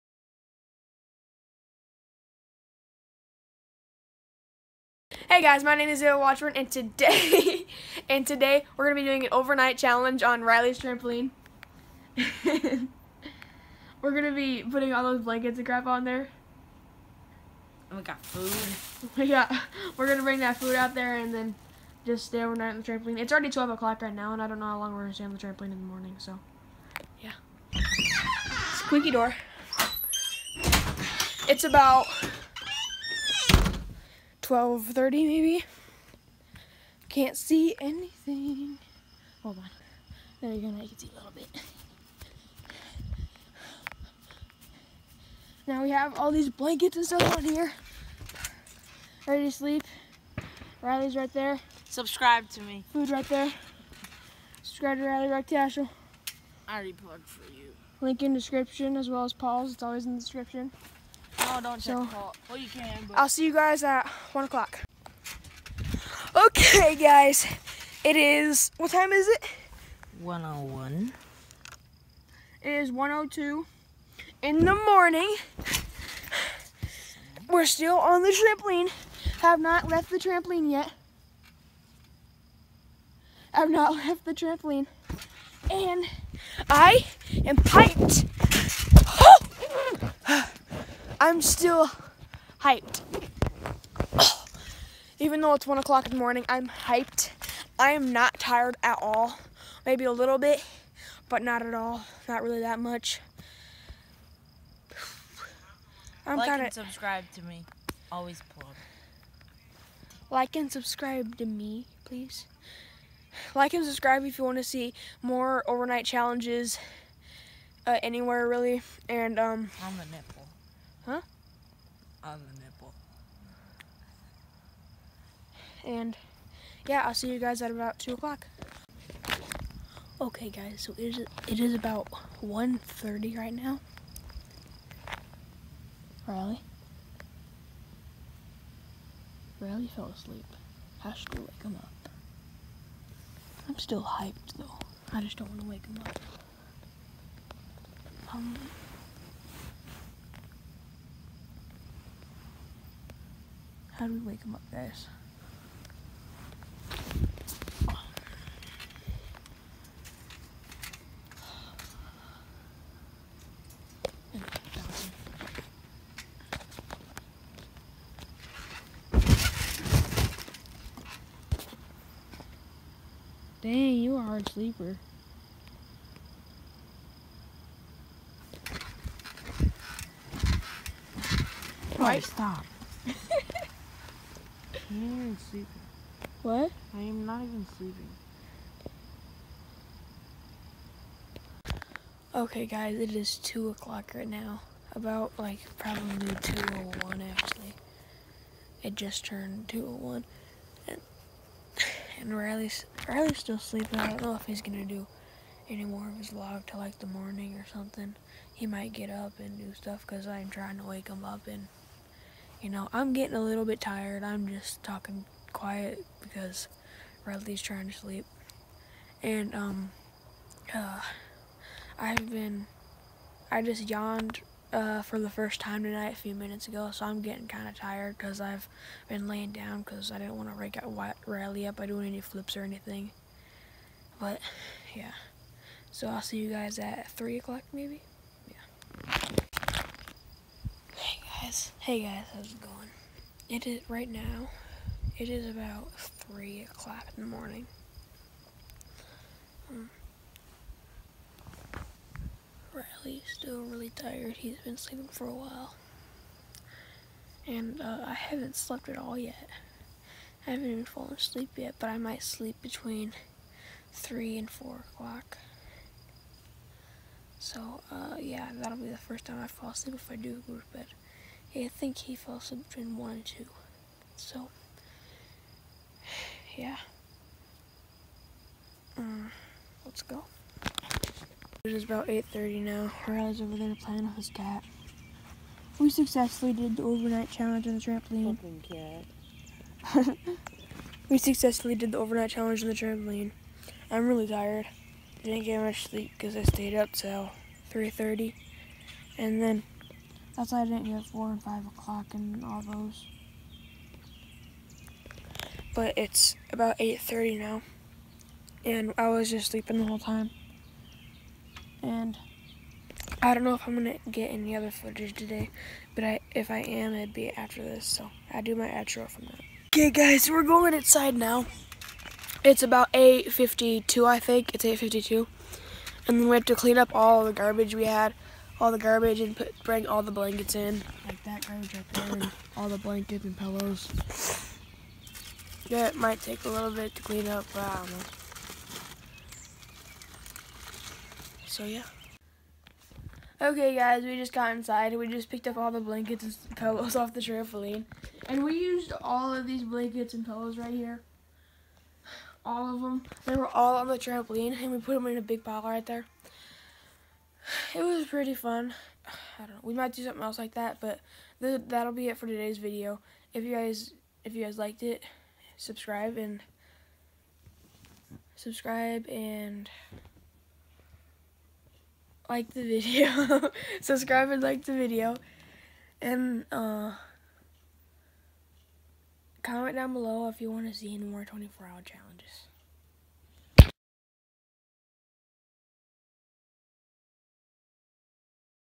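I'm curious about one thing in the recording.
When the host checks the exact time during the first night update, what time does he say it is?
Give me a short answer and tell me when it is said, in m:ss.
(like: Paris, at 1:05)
1:02, at 1:12.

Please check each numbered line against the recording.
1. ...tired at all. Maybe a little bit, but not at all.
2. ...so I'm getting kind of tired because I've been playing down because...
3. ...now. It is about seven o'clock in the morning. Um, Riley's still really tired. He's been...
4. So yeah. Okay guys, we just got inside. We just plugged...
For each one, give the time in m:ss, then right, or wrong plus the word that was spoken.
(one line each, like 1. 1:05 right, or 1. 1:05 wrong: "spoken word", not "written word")
1. 1:38 right
2. 3:46 wrong: "laying", not "playing"
3. 4:04 wrong: "three", not "seven"
4. 5:41 wrong: "picked", not "plugged".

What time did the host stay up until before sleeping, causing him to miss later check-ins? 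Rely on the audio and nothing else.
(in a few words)
3:30.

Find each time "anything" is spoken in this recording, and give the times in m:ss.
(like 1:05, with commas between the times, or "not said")
0:37, 3:52.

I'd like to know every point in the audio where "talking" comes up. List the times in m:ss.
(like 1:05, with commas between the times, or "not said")
3:34.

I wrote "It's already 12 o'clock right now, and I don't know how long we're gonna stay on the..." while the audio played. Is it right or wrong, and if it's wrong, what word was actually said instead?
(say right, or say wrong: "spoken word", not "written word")
right.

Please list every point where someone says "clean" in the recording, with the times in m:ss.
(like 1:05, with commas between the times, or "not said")
5:26, 5:37.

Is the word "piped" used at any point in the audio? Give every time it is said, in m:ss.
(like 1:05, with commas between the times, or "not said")
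1:27.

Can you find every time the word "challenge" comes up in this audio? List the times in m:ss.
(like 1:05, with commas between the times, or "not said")
0:09, 1:56, 4:47, 4:52, 6:21.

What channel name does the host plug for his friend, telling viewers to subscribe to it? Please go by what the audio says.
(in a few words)
Riley Rock Cashel.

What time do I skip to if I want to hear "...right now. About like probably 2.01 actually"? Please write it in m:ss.
3:14.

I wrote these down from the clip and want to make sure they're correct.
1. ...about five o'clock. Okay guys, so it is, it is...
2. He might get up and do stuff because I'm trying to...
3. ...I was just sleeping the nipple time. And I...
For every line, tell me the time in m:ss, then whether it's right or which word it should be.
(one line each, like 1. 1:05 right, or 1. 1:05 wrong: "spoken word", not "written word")
1. 2:07 wrong: "two", not "five"
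2. 3:28 right
3. 5:08 wrong: "whole", not "nipple".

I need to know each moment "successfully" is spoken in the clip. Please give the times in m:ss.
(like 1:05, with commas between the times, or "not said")
4:45, 4:51.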